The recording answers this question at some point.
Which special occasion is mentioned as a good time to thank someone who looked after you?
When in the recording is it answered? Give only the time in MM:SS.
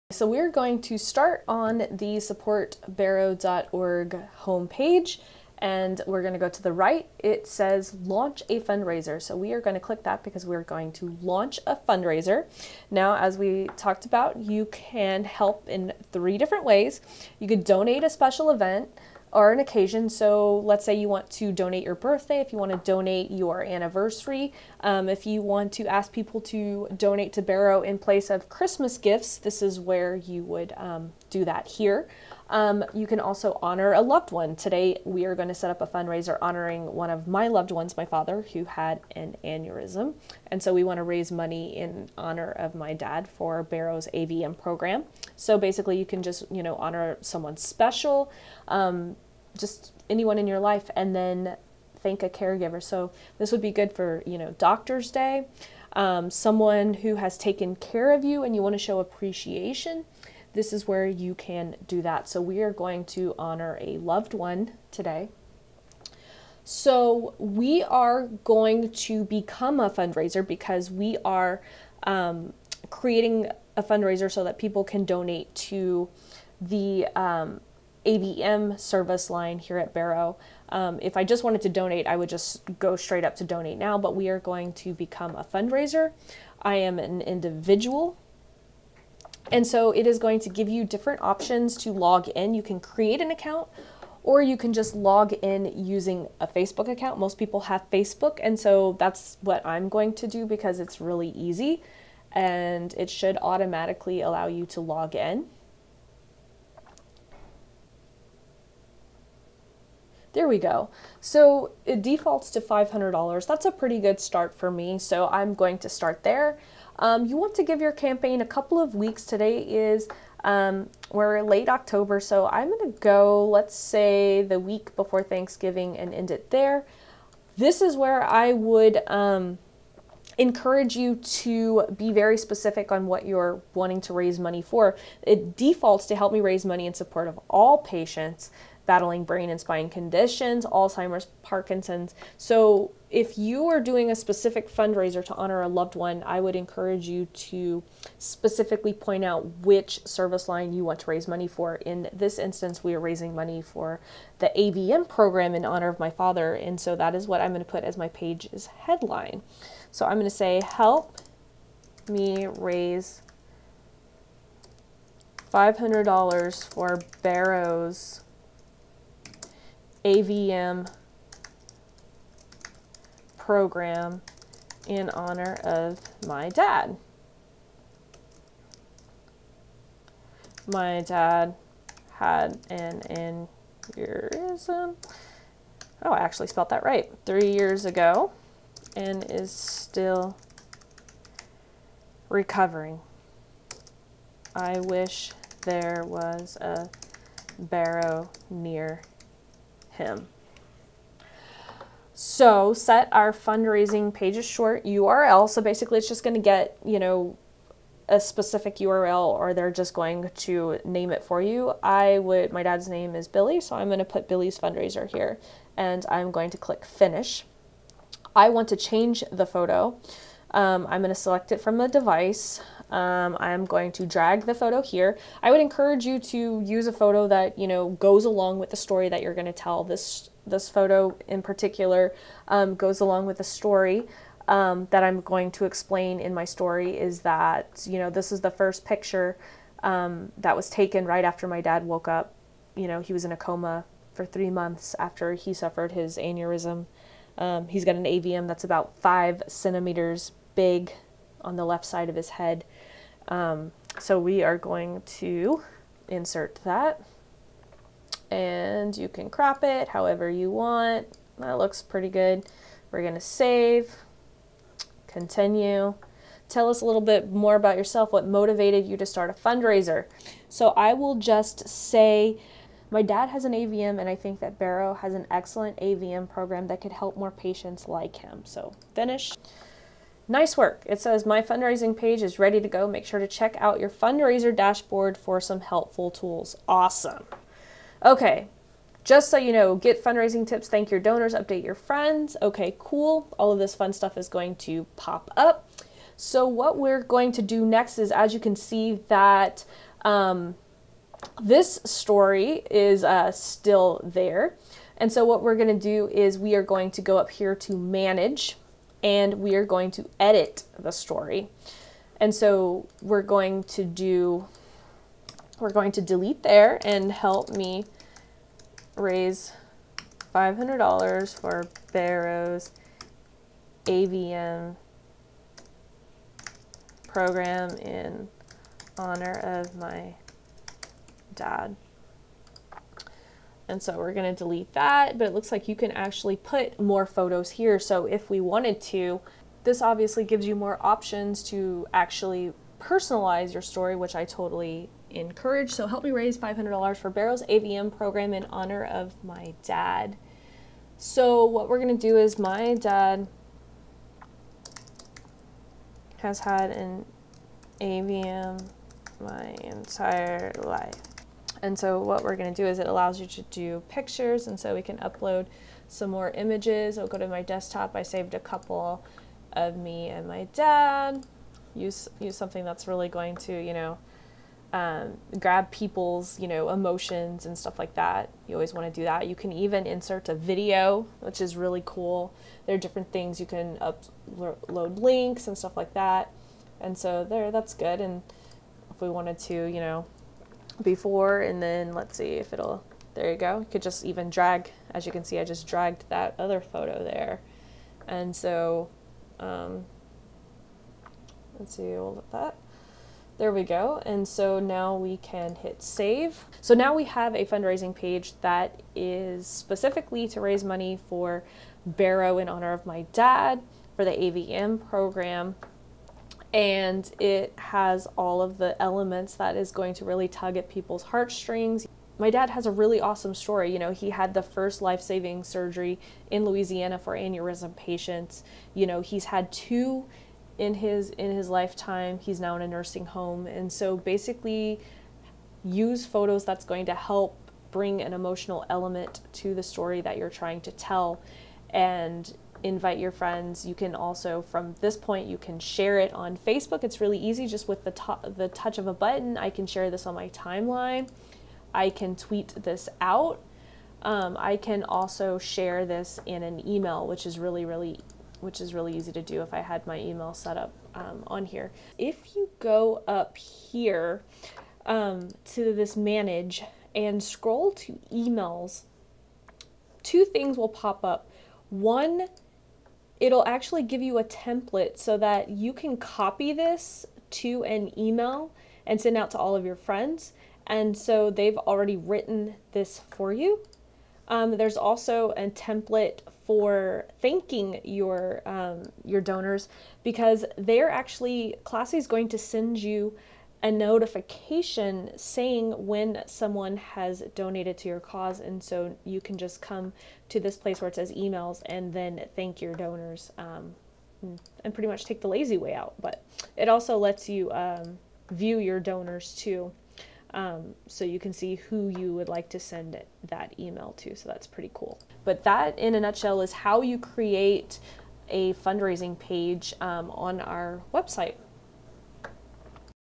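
00:54.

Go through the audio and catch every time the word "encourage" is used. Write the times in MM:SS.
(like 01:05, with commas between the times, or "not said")
02:10, 02:26, 03:45, 05:45.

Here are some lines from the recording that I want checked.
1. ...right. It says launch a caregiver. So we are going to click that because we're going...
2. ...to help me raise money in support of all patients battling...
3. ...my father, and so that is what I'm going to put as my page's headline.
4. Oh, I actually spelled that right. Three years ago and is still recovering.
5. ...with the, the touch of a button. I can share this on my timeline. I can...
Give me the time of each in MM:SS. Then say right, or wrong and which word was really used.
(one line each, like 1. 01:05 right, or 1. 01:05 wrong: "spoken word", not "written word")
1. 00:06 wrong: "fundraiser", not "caregiver"
2. 02:16 right
3. 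02:35 right
4. 03:06 right
5. 07:27 right.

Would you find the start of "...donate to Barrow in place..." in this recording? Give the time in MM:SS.
00:26.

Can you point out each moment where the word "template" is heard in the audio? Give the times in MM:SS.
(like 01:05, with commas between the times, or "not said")
07:54, 08:05.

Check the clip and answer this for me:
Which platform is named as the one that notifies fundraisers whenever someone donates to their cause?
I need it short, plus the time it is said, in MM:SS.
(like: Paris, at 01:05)
Classy, at 08:11.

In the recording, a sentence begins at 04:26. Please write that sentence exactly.
Tell us a little bit more about yourself, what motivated you to start a fundraiser.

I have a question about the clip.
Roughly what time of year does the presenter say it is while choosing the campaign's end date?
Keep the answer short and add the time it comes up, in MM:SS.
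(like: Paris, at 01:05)
Late October, at 02:01.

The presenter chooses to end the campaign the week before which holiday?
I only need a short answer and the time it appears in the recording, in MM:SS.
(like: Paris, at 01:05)
Thanksgiving, at 02:05.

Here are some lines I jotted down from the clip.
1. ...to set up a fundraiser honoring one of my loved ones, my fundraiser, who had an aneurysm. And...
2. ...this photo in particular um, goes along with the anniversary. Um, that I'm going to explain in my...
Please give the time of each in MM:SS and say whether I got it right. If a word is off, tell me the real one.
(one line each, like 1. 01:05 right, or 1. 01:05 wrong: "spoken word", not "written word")
1. 00:35 wrong: "father", not "fundraiser"
2. 03:50 wrong: "story", not "anniversary".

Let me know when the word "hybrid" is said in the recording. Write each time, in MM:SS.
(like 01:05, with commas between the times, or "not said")
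not said.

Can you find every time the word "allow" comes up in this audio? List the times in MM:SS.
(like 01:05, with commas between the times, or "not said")
01:44, 06:02.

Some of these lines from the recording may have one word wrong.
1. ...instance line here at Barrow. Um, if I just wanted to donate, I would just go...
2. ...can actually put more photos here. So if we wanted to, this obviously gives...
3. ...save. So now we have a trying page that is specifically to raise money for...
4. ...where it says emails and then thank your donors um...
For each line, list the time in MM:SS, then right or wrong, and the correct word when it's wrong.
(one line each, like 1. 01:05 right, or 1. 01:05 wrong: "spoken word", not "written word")
1. 01:18 wrong: "service", not "instance"
2. 05:35 right
3. 06:45 wrong: "fundraising", not "trying"
4. 08:20 right.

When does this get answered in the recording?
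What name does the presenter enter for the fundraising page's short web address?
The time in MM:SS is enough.
03:34.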